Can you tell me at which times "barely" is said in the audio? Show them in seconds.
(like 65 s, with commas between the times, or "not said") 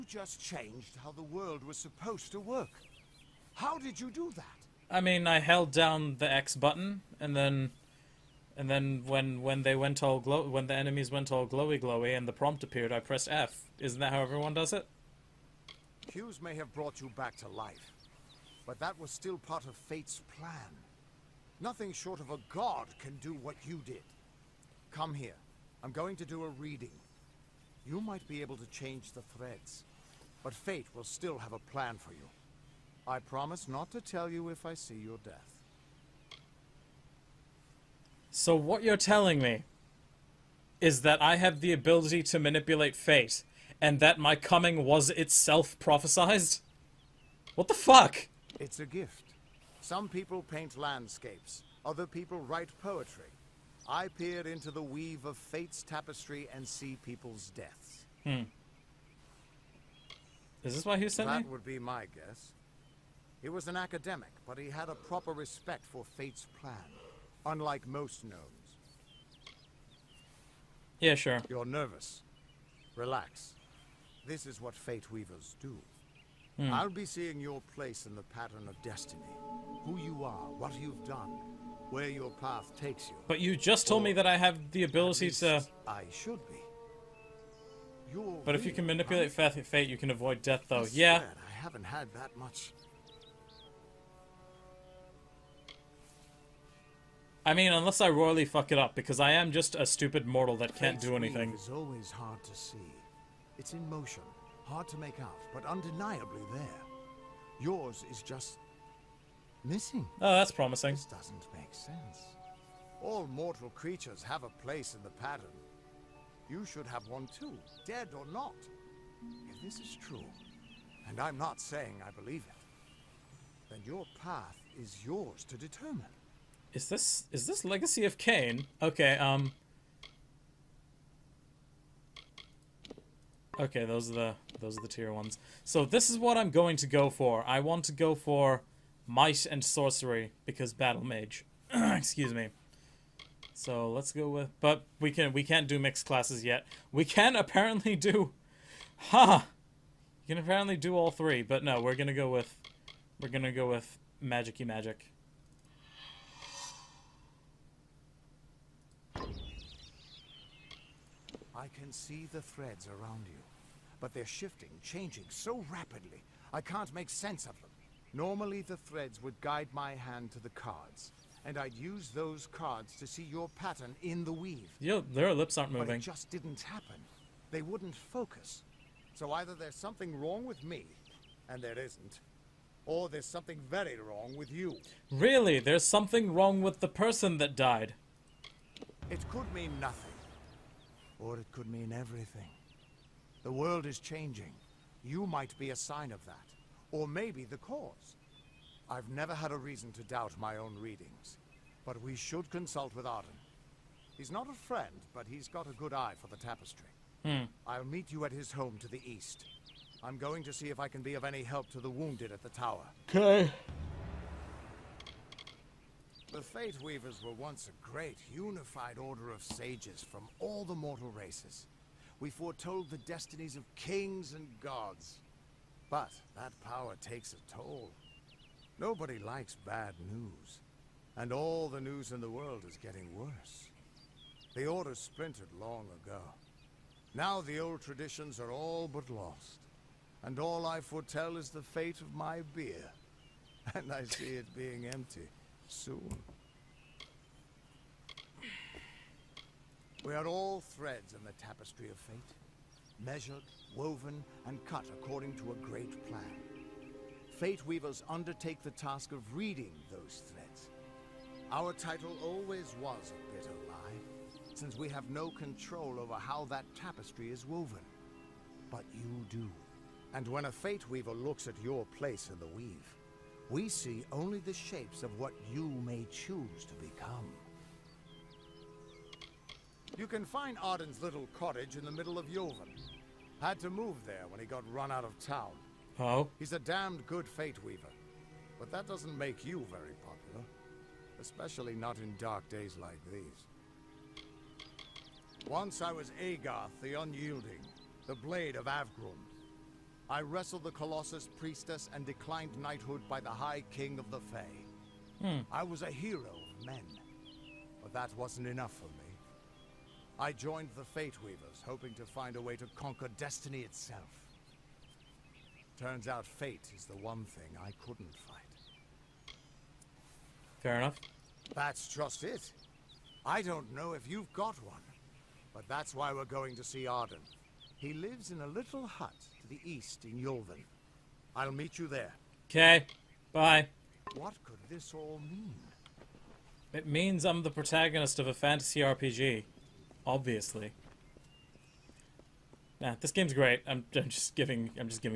not said.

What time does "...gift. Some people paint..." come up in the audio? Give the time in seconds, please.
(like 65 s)
48 s.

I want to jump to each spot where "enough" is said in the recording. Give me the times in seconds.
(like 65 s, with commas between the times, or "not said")
308 s, 320 s.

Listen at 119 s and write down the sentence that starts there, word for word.
If this is true, and I'm not saying I believe it, then your path is yours to determine.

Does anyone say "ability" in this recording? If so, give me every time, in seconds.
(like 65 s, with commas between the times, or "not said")
41 s, 84 s.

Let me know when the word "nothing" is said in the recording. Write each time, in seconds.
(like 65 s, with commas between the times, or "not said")
21 s, 189 s.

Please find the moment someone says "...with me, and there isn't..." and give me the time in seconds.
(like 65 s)
180 s.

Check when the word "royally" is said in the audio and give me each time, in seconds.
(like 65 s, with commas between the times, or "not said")
98 s.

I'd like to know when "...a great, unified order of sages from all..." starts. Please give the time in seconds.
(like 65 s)
217 s.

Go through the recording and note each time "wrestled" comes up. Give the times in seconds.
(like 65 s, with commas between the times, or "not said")
300 s.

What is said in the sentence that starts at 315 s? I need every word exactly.
Turns out fate is the one thing I couldn't fight.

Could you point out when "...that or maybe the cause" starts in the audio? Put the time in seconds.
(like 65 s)
196 s.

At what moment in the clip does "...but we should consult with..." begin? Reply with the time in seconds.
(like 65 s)
201 s.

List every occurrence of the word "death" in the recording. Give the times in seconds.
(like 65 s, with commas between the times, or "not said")
35 s, 57 s, 90 s.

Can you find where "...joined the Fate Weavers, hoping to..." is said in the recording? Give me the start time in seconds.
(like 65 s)
310 s.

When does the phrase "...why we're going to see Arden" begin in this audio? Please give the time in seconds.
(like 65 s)
325 s.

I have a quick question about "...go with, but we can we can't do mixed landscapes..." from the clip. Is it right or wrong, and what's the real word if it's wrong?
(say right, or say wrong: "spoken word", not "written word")
wrong: "classes", not "landscapes".